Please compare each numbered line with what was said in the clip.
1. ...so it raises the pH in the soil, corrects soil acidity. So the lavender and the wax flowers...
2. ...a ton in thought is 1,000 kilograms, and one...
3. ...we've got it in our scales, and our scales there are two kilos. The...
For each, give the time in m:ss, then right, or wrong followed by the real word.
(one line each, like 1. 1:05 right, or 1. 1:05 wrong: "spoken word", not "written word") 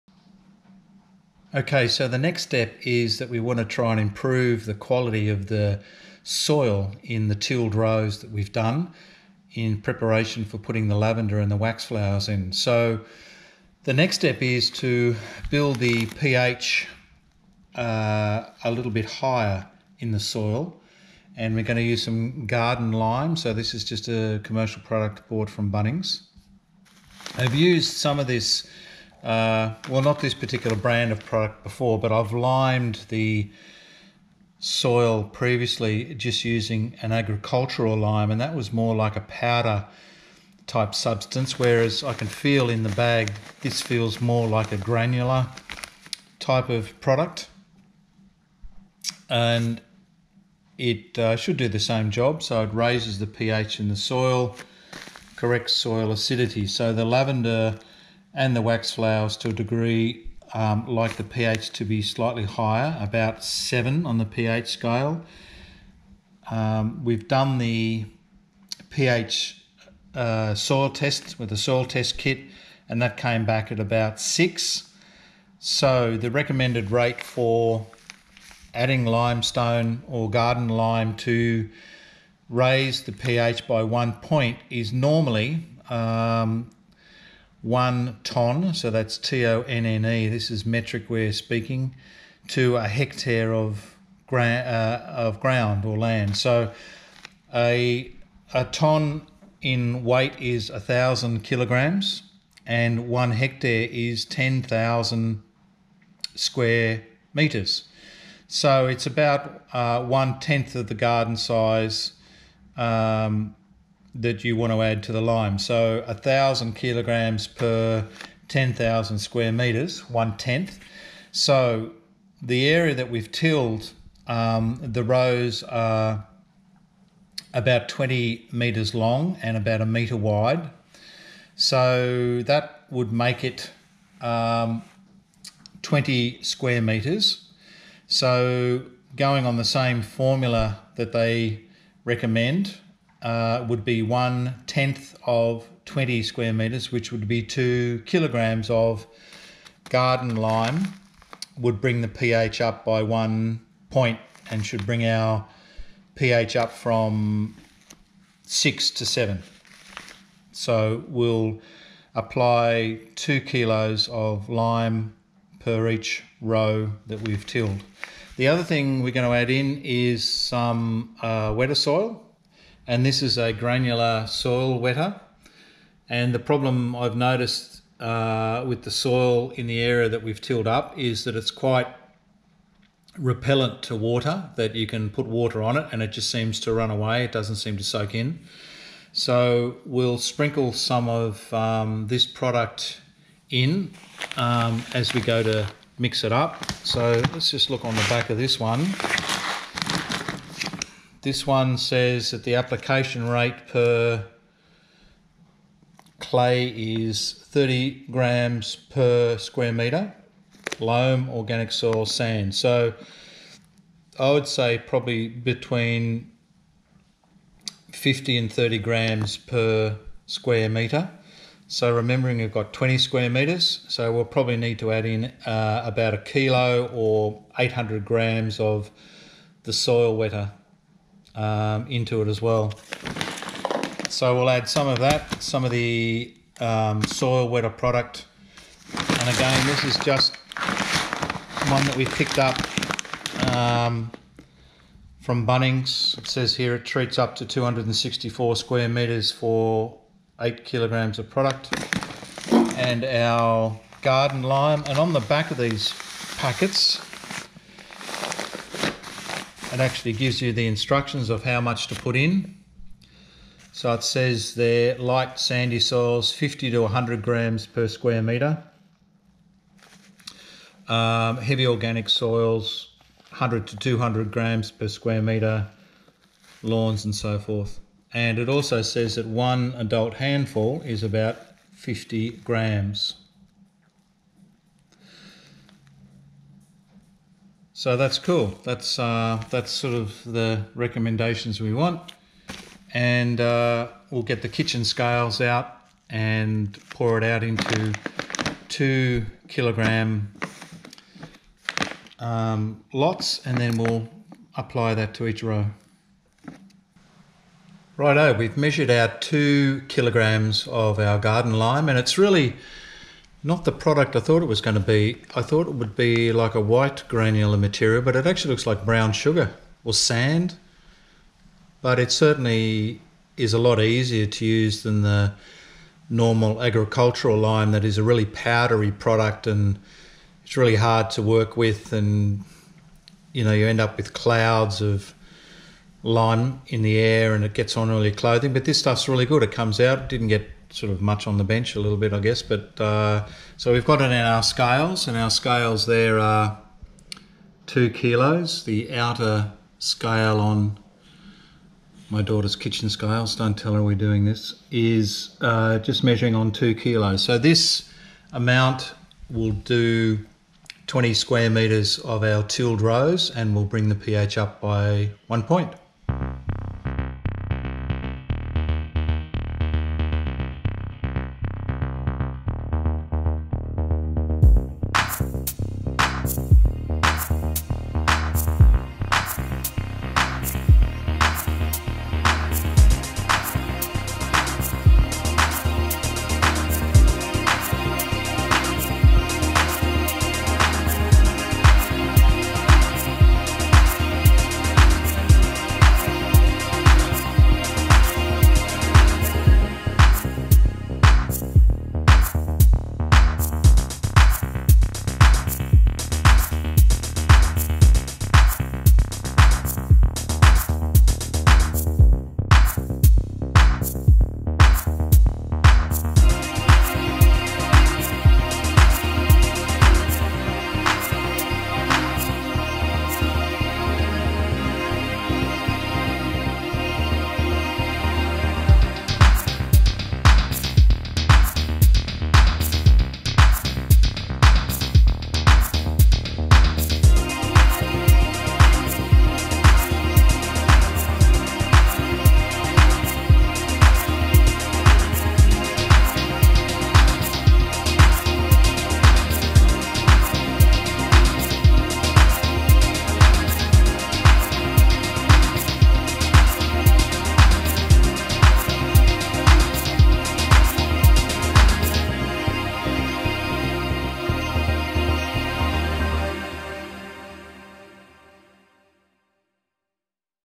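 1. 0:52 right
2. 1:38 wrong: "weight", not "thought"
3. 5:43 right.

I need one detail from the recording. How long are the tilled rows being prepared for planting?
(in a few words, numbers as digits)
about 20 meters.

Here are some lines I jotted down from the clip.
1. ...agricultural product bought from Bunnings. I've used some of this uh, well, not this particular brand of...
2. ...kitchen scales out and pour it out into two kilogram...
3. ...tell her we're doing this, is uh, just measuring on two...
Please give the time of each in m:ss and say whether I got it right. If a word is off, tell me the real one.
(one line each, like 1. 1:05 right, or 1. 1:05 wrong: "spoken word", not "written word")
1. 0:24 wrong: "commercial", not "agricultural"
2. 4:54 right
3. 5:53 right.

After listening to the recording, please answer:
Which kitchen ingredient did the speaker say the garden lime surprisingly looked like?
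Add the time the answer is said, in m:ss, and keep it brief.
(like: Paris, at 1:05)
brown sugar, at 5:18.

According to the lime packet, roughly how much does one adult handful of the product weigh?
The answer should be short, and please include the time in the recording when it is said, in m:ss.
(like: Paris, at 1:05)
50 grams, at 4:41.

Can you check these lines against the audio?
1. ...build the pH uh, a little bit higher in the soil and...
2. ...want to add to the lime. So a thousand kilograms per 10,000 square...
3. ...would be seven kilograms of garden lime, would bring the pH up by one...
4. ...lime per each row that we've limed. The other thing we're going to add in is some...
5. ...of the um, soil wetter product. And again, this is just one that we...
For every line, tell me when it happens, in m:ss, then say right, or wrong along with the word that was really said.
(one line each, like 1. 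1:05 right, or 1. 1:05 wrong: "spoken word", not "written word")
1. 0:15 right
2. 1:54 right
3. 2:27 wrong: "two", not "seven"
4. 2:44 wrong: "tilled", not "limed"
5. 3:55 right.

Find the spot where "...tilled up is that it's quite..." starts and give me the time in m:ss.
3:00.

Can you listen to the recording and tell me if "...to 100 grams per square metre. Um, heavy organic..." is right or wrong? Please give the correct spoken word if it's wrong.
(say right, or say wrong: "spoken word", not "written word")
right.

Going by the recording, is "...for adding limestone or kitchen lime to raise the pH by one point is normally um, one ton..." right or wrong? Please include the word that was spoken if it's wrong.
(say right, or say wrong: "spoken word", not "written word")
wrong: "garden", not "kitchen".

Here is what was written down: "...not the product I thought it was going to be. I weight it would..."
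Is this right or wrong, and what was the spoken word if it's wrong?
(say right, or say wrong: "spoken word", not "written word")
wrong: "thought", not "weight".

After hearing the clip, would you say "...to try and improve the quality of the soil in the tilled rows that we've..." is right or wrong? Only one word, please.
right.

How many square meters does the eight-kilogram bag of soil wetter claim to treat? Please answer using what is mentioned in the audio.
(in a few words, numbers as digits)
264 square meters.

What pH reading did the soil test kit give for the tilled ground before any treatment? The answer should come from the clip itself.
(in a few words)
about 6.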